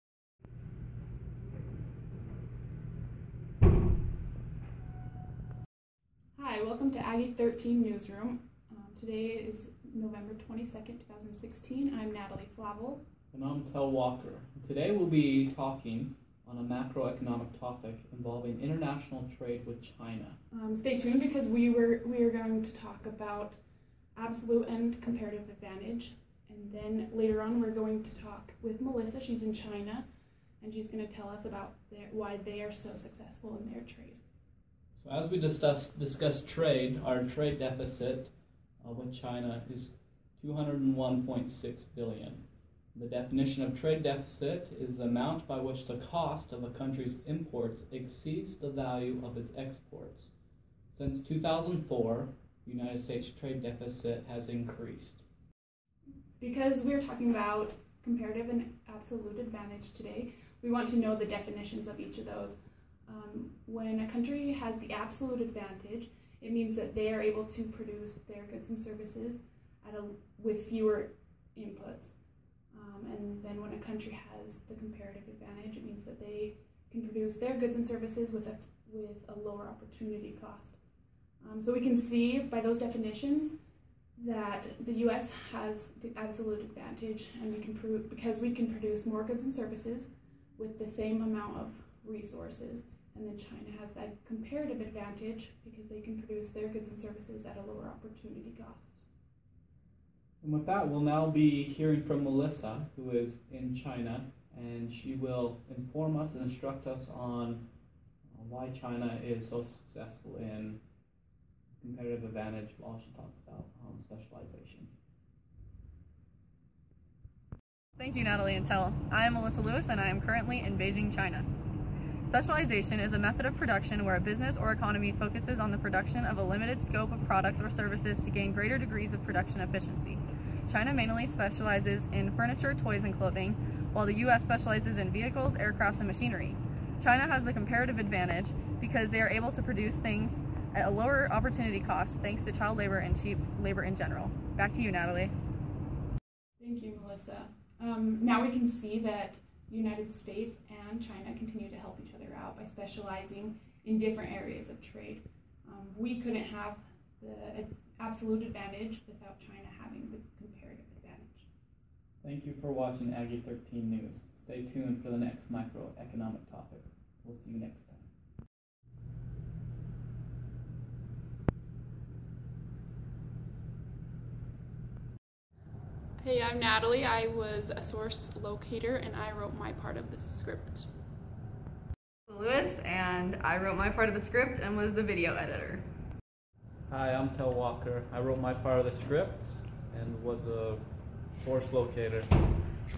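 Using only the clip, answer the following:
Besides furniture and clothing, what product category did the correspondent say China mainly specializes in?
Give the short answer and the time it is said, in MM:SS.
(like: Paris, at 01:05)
Toys, at 02:12.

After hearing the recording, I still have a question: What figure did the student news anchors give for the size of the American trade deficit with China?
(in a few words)
201.6 billion.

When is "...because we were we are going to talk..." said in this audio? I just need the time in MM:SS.
00:21.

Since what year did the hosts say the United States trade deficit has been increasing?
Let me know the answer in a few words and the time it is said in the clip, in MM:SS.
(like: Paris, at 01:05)
2004, at 00:51.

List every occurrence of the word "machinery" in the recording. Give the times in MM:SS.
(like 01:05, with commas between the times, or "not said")
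02:16.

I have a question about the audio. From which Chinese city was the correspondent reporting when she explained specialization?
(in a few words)
Beijing.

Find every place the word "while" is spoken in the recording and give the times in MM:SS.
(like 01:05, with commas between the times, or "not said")
01:52, 02:13.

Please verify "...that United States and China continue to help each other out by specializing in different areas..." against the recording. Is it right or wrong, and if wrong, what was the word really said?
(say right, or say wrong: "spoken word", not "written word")
right.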